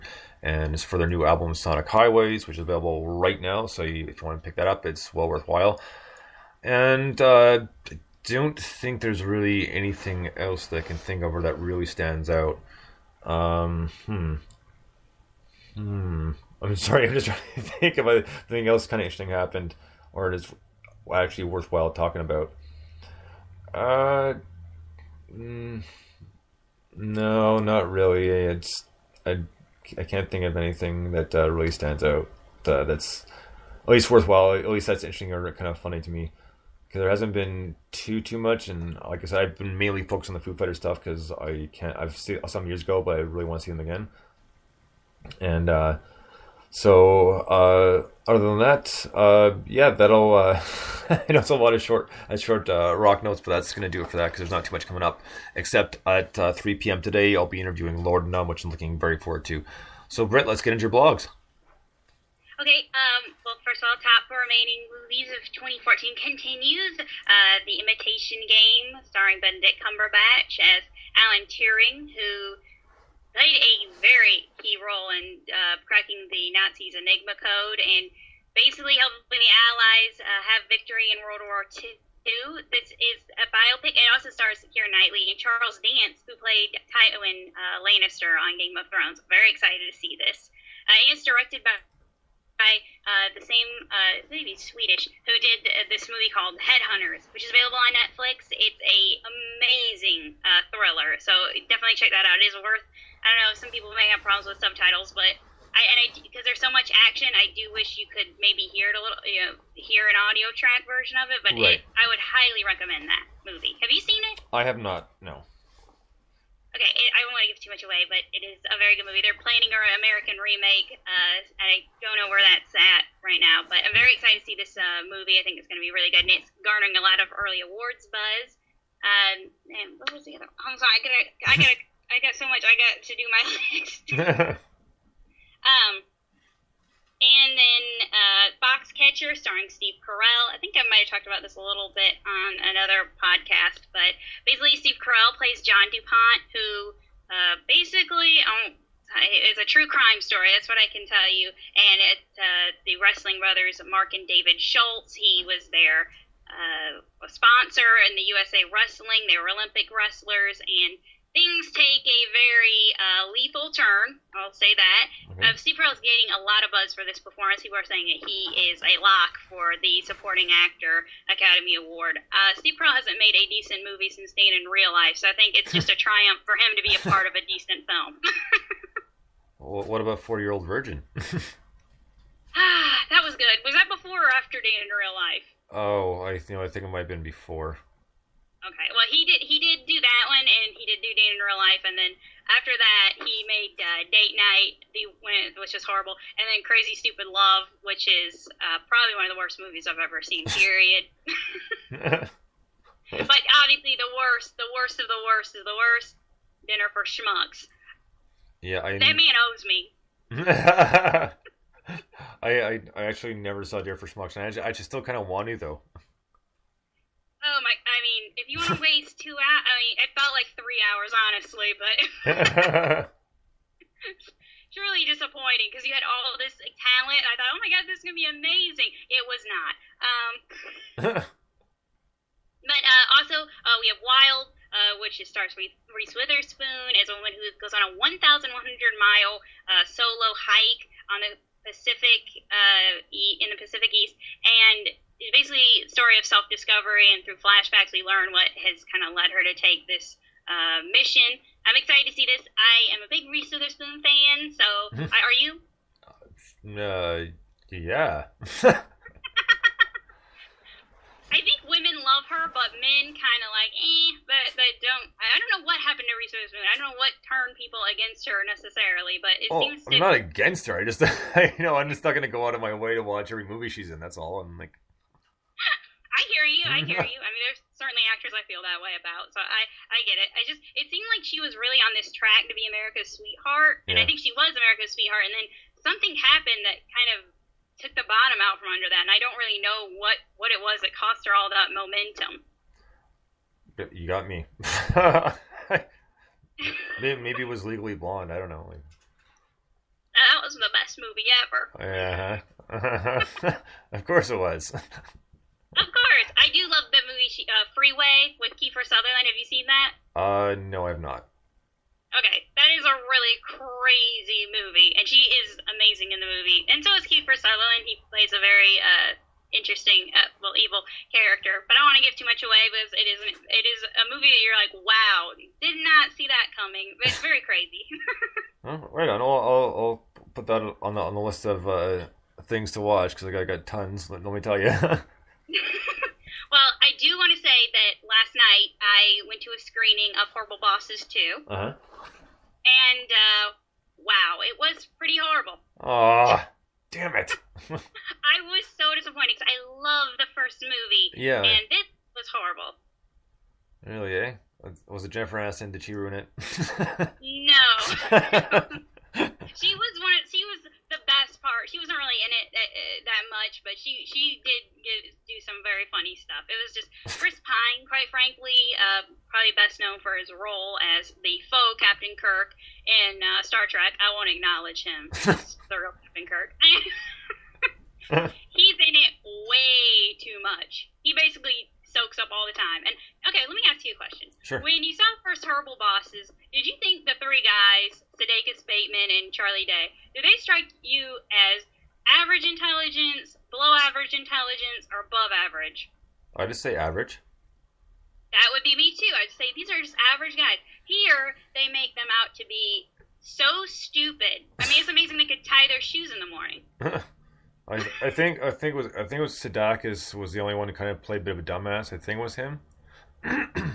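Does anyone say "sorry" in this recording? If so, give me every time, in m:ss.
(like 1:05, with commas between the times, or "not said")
0:16, 2:10.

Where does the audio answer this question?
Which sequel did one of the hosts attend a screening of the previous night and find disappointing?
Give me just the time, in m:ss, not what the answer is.
5:40.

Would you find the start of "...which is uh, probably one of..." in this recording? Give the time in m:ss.
3:17.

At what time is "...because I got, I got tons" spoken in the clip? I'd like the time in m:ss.
5:33.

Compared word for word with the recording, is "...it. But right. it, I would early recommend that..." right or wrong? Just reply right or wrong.
wrong.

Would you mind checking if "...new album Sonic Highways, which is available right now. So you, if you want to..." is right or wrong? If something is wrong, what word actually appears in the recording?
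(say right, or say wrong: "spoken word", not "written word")
right.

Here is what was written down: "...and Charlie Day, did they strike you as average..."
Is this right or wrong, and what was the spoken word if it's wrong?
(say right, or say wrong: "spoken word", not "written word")
right.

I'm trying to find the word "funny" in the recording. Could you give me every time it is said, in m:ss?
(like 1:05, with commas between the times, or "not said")
0:35, 6:05.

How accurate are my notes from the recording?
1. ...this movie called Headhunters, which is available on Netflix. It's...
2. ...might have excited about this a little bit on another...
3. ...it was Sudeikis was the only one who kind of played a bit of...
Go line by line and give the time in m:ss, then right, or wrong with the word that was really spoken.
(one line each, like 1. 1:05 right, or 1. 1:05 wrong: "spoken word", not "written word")
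1. 1:35 right
2. 2:20 wrong: "talked", not "excited"
3. 6:49 right.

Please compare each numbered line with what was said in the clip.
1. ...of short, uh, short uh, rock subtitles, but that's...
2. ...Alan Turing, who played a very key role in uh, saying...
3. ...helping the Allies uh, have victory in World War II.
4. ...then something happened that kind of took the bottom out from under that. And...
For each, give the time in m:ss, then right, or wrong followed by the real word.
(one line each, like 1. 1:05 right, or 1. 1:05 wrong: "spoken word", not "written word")
1. 0:51 wrong: "notes", not "subtitles"
2. 1:11 wrong: "cracking", not "saying"
3. 1:18 right
4. 4:45 right.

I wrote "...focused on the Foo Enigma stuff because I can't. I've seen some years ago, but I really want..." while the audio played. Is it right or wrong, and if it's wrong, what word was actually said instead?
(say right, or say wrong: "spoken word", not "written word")
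wrong: "Fighter", not "Enigma".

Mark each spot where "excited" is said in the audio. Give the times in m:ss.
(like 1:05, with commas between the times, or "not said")
1:29, 2:04, 4:11.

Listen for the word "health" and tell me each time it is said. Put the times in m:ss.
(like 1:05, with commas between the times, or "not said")
not said.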